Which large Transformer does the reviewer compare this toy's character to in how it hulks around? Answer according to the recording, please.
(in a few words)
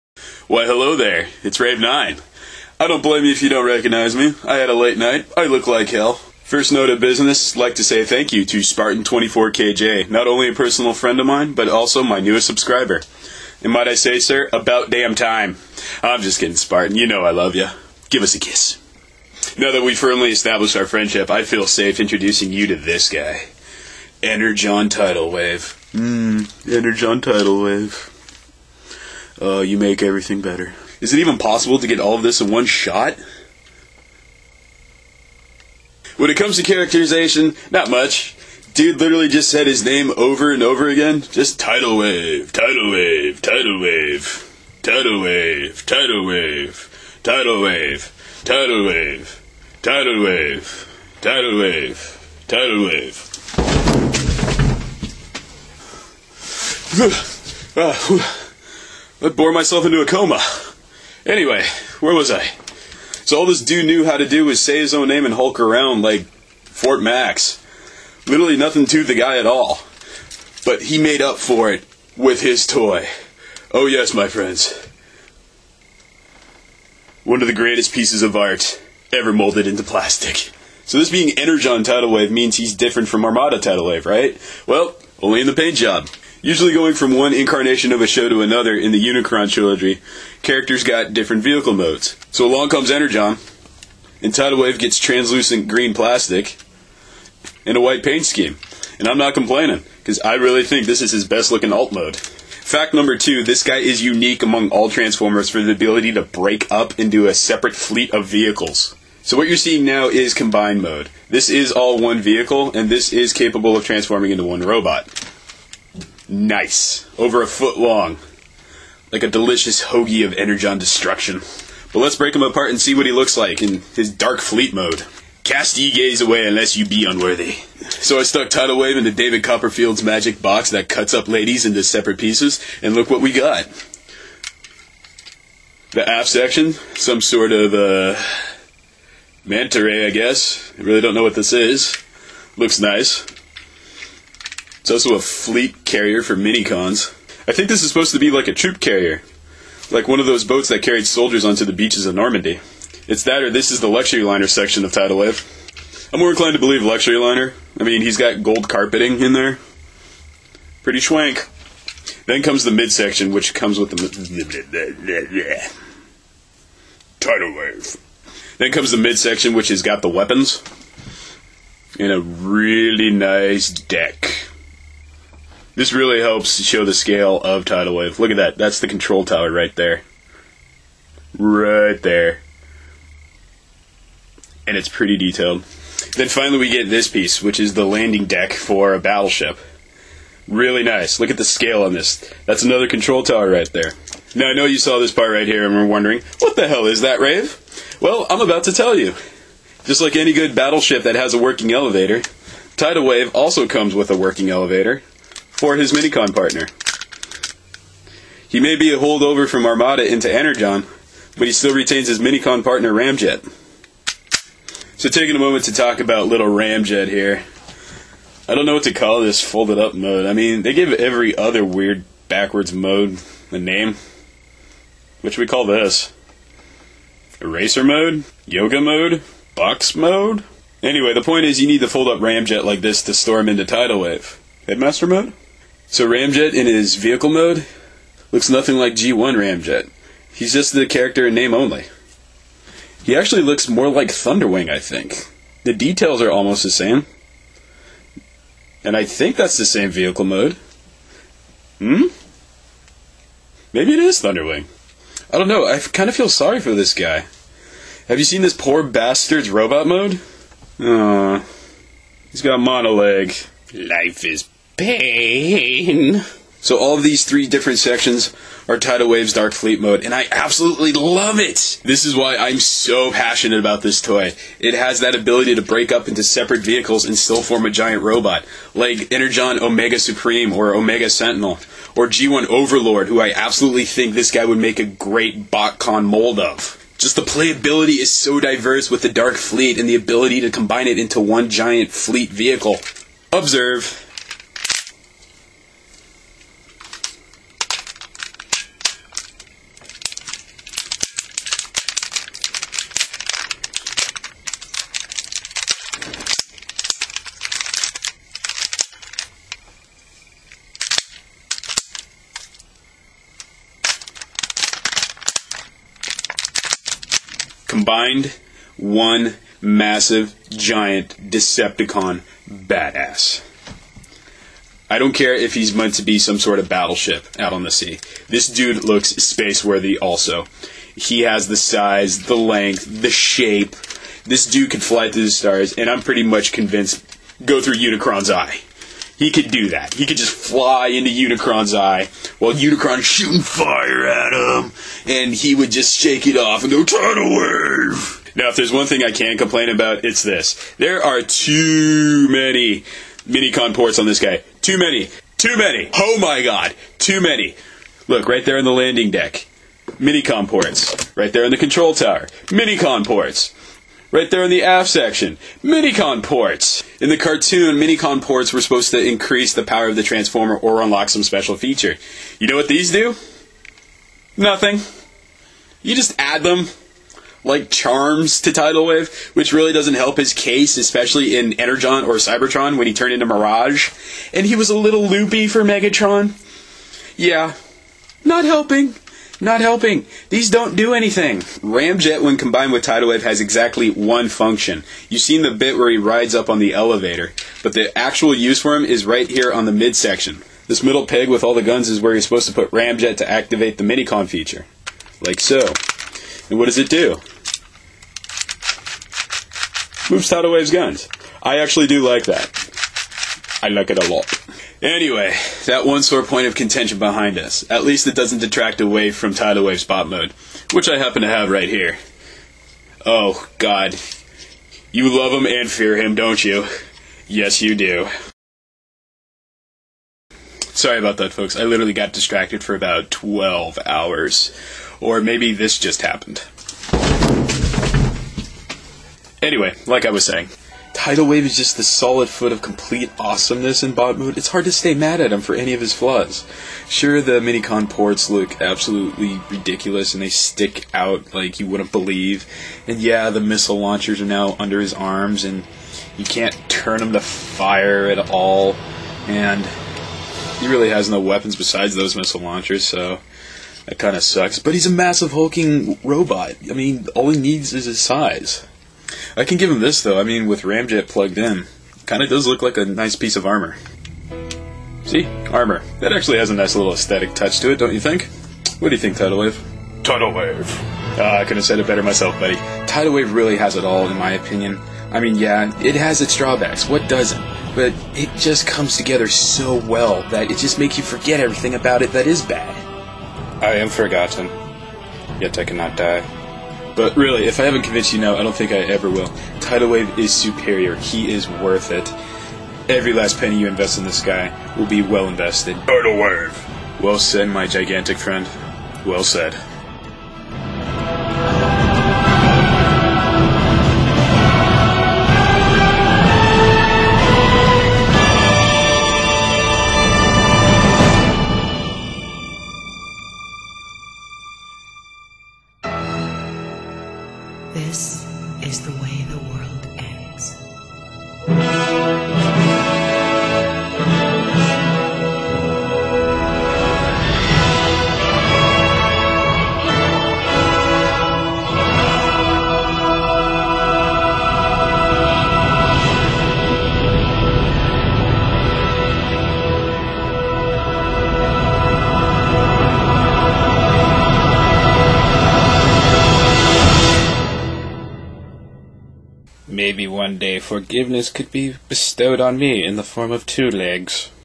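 Fort Max.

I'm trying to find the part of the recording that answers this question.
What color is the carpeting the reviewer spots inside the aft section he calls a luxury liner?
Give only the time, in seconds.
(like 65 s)
158 s.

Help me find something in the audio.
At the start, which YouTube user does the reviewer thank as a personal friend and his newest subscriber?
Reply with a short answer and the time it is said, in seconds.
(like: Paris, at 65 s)
Spartan24KJ, at 8 s.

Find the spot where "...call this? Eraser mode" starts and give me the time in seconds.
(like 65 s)
225 s.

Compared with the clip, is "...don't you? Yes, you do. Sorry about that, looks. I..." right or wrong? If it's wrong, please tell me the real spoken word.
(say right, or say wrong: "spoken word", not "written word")
wrong: "folks", not "looks".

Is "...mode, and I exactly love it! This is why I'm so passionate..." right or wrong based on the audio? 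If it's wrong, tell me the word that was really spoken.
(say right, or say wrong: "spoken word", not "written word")
wrong: "absolutely", not "exactly".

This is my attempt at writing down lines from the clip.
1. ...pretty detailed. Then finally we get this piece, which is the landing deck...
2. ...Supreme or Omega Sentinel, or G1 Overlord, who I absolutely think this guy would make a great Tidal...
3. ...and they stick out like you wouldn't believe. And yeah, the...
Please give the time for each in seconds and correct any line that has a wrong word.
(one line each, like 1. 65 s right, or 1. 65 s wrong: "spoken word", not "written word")
1. 184 s right
2. 279 s wrong: "BotCon", not "Tidal"
3. 450 s right.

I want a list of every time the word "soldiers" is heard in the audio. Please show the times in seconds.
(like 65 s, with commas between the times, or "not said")
151 s.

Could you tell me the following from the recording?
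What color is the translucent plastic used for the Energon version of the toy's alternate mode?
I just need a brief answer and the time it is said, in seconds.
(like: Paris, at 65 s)
green, at 95 s.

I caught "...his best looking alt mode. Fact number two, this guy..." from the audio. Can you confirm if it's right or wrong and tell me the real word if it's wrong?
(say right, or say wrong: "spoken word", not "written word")
right.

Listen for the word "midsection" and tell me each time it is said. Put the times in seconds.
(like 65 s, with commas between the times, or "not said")
162 s, 168 s, 399 s.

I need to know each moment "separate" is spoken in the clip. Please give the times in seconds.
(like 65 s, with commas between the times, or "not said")
107 s, 131 s, 276 s.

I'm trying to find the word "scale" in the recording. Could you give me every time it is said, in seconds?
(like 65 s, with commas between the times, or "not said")
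176 s, 191 s.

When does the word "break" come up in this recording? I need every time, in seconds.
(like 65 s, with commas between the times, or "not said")
106 s, 122 s, 275 s.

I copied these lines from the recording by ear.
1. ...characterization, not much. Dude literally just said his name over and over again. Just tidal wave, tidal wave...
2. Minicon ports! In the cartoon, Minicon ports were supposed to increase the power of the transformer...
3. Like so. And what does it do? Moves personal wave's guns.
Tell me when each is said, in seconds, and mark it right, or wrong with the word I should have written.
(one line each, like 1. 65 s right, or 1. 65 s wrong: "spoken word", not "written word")
1. 36 s right
2. 365 s right
3. 405 s wrong: "tidal", not "personal".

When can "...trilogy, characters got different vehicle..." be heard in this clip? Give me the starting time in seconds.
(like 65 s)
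89 s.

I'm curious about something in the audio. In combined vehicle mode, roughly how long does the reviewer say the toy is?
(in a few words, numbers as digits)
over a foot.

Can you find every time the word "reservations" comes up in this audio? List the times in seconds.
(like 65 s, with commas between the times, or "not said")
not said.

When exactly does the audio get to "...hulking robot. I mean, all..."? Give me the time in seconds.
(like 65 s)
465 s.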